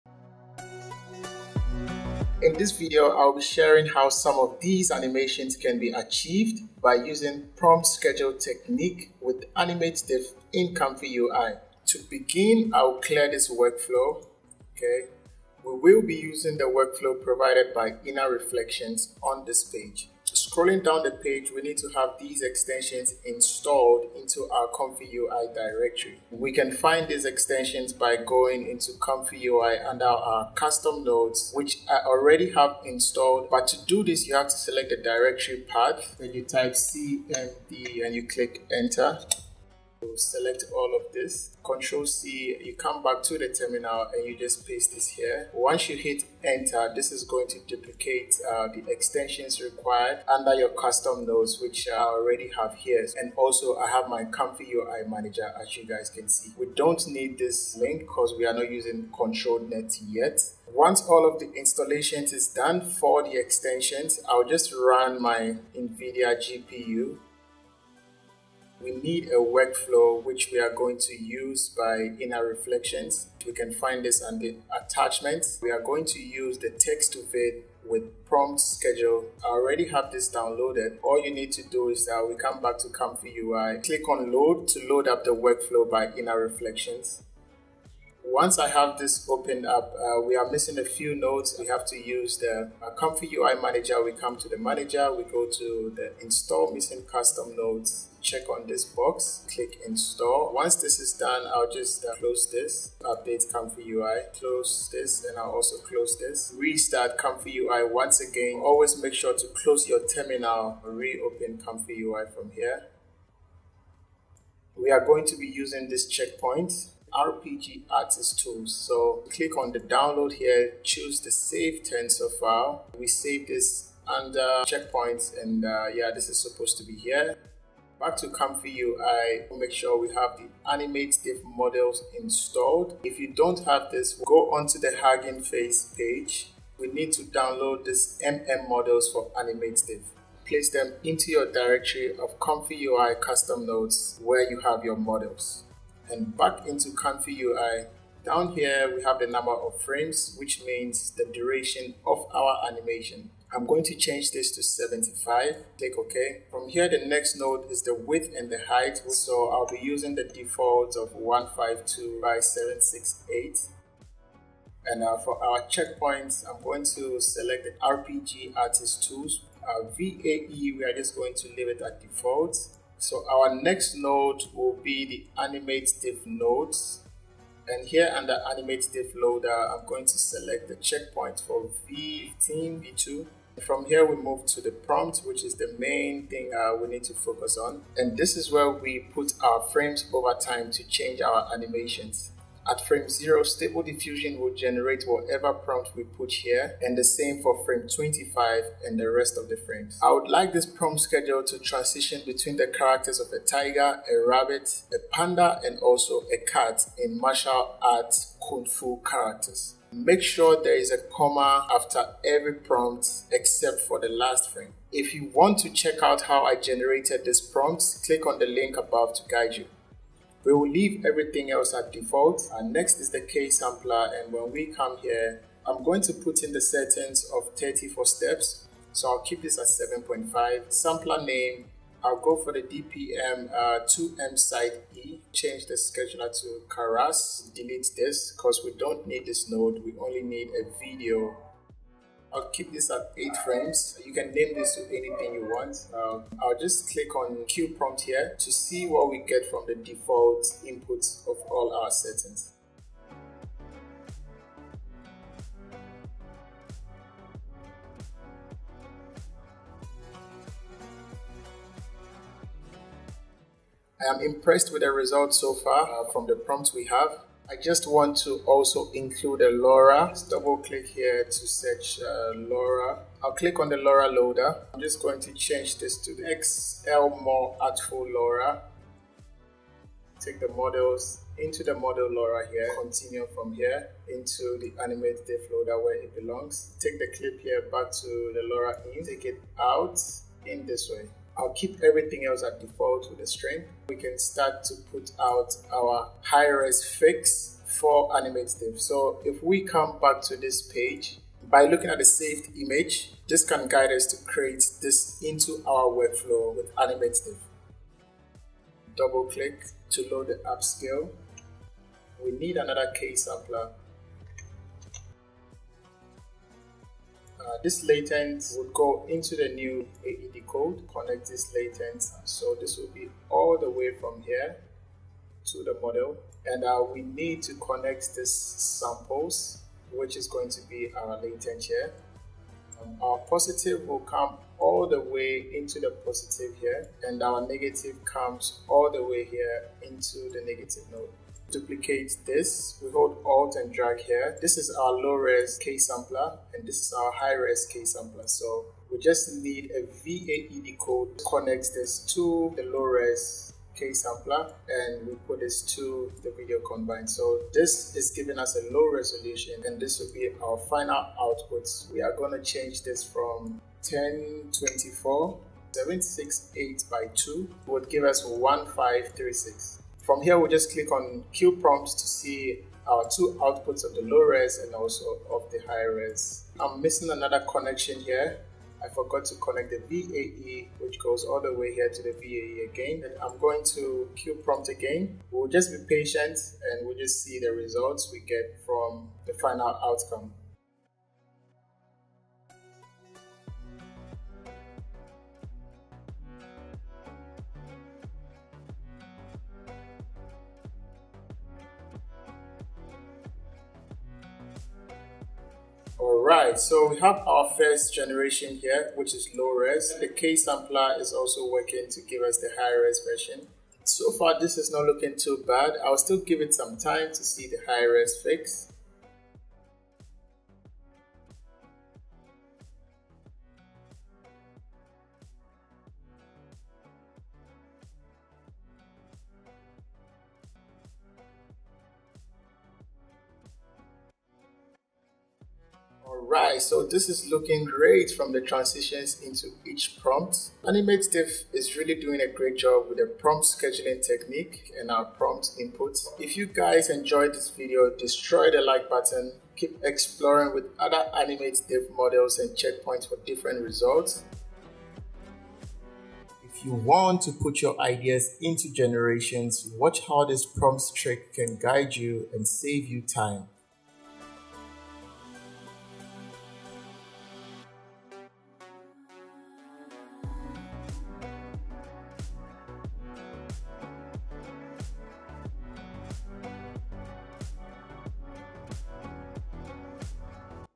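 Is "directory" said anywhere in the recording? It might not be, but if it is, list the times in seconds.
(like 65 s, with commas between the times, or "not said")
25 s, 34 s, 141 s.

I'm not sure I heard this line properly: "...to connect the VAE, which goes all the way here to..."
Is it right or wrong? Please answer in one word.
right.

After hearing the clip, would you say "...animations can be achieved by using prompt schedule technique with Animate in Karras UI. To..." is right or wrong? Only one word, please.
wrong.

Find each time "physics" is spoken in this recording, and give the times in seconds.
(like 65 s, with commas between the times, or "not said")
not said.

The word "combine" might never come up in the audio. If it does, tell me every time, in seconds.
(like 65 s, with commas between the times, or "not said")
356 s.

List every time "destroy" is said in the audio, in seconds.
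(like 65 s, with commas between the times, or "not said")
447 s.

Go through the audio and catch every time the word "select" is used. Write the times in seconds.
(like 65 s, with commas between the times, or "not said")
34 s, 40 s, 167 s, 180 s.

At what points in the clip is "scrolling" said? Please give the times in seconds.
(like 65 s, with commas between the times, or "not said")
20 s.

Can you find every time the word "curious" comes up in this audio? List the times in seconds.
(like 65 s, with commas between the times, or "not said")
not said.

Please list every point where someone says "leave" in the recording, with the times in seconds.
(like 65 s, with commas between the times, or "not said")
171 s, 220 s.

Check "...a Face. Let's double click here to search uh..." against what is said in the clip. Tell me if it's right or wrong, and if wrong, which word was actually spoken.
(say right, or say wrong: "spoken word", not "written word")
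wrong: "LoRa", not "Face".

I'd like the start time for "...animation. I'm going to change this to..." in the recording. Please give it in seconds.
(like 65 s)
152 s.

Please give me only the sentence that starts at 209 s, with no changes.
Make sure there is a comma after every prompt except for the last frame.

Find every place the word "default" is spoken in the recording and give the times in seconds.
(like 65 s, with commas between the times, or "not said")
160 s, 172 s, 221 s, 249 s, 292 s.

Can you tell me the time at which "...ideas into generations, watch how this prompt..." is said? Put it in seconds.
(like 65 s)
457 s.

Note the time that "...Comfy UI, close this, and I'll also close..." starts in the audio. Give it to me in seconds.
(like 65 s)
103 s.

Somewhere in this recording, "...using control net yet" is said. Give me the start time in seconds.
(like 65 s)
58 s.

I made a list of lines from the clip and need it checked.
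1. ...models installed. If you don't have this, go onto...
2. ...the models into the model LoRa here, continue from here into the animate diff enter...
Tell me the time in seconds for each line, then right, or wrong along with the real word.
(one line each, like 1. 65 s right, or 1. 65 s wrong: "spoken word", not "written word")
1. 131 s right
2. 280 s wrong: "loader", not "enter".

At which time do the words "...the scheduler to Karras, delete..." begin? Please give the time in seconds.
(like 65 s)
235 s.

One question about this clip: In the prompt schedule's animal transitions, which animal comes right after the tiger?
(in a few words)
rabbit.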